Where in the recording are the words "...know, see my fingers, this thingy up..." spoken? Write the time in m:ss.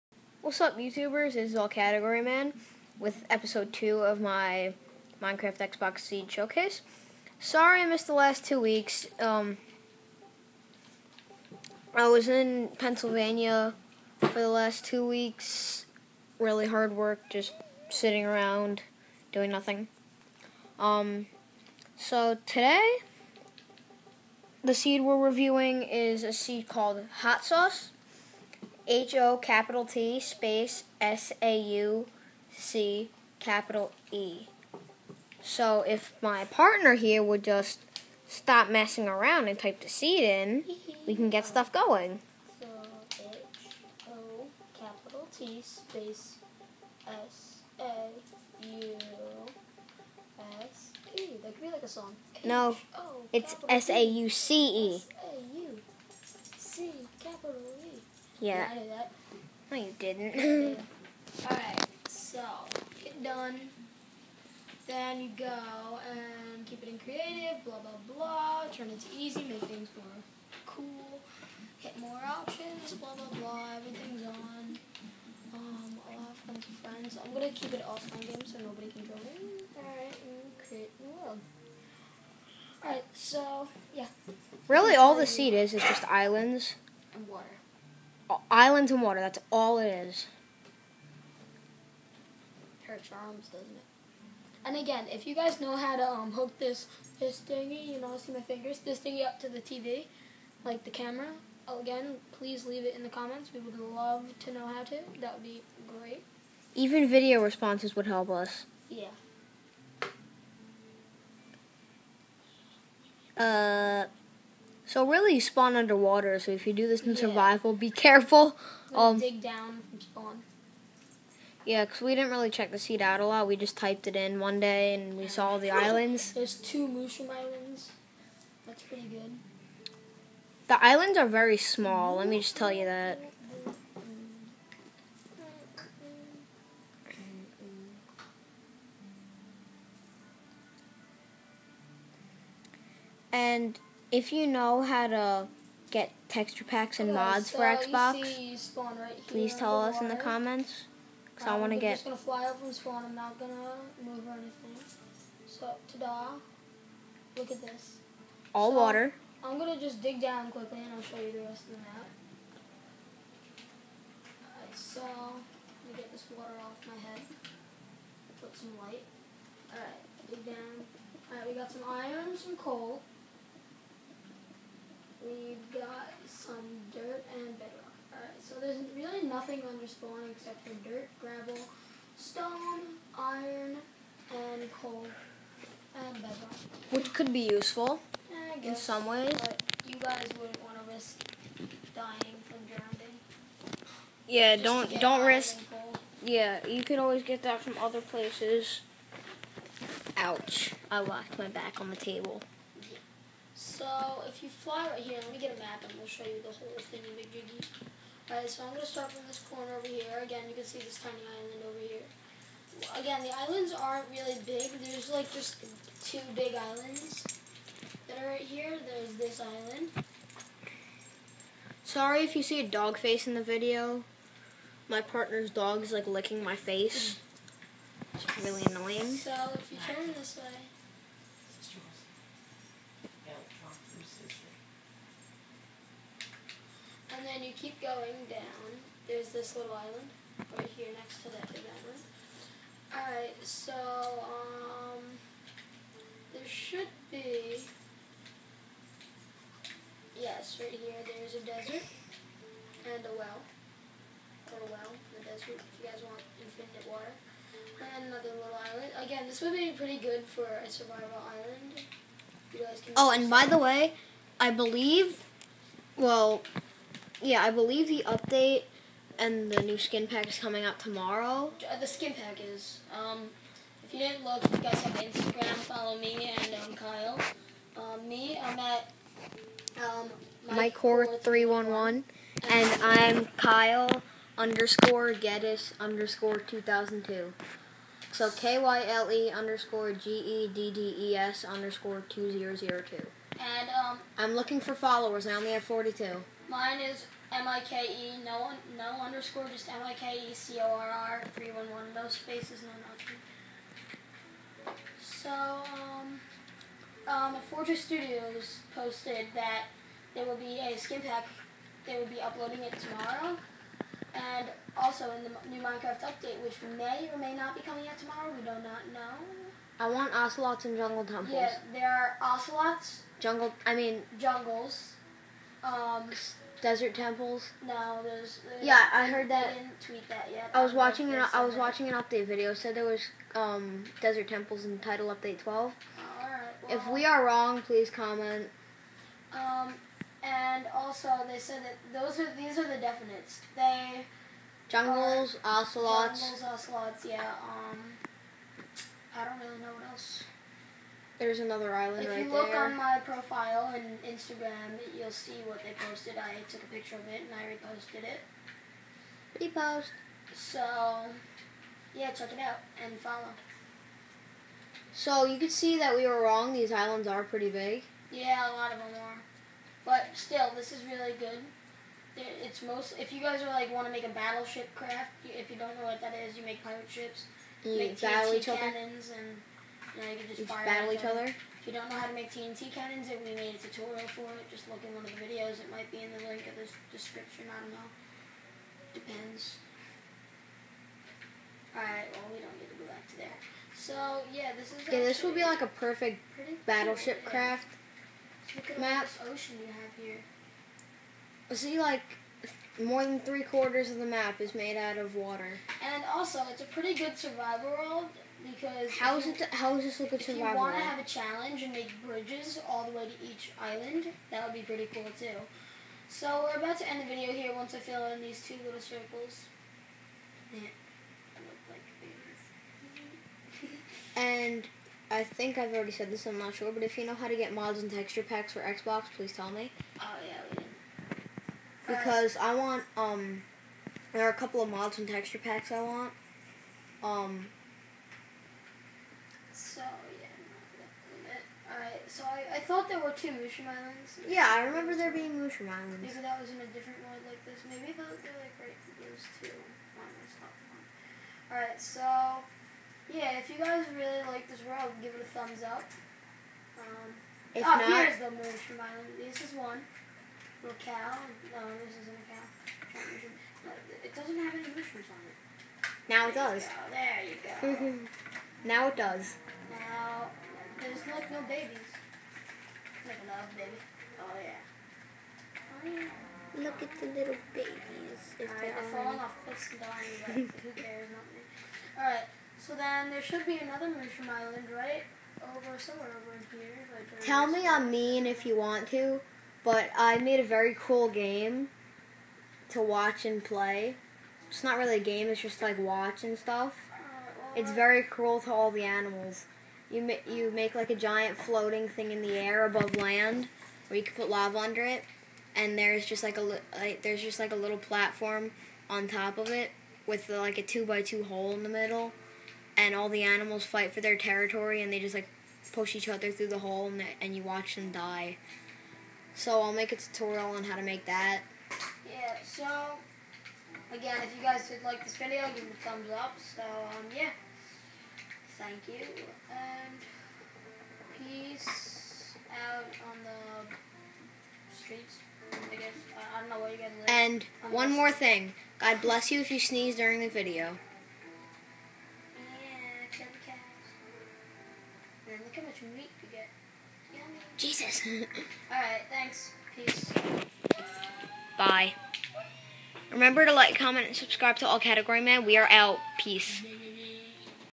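1:37.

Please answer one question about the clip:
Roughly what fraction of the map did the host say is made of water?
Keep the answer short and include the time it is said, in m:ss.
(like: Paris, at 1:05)
More than three quarters, at 6:42.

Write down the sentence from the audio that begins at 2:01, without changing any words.
Yeah, because we didn't really check the seed out a lot.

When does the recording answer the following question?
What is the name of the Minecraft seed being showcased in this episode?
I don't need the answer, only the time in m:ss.
0:27.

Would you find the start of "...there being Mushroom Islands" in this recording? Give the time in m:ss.
7:24.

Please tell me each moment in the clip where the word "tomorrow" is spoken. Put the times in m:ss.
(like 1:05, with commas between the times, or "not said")
4:30, 5:12, 5:17.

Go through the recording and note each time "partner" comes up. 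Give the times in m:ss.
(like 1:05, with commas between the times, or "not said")
0:36, 3:45.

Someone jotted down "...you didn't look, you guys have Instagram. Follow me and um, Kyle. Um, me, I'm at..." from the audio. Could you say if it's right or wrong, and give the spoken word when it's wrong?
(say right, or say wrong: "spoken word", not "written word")
right.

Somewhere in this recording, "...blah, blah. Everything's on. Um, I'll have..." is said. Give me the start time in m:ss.
1:13.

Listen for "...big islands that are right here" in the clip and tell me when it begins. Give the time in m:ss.
3:36.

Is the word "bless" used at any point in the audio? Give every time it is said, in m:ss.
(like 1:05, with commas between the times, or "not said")
8:59.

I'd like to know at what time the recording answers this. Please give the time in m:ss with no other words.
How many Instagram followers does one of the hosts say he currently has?
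4:55.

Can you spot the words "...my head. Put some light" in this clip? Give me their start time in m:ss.
2:46.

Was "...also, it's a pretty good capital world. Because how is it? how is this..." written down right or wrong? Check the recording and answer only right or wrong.
wrong.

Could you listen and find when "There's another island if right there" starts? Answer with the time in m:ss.
5:51.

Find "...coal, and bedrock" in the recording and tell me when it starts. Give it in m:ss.
3:04.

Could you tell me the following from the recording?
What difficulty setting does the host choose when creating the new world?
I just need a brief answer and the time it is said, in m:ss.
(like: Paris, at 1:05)
Easy, at 1:09.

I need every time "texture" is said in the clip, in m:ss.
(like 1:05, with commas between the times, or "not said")
2:26, 7:07, 7:15.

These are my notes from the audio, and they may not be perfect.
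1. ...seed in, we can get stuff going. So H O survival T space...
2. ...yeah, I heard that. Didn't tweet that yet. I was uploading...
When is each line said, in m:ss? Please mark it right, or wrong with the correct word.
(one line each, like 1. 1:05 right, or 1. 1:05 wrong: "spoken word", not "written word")
1. 0:39 wrong: "capital", not "survival"
2. 5:28 wrong: "watching", not "uploading".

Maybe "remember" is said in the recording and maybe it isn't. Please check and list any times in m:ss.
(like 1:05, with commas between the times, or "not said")
7:24, 9:13.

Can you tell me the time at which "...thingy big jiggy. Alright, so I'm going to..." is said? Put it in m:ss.
3:26.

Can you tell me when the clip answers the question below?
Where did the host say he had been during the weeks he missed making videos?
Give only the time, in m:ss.
0:12.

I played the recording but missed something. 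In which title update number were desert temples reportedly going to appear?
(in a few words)
12.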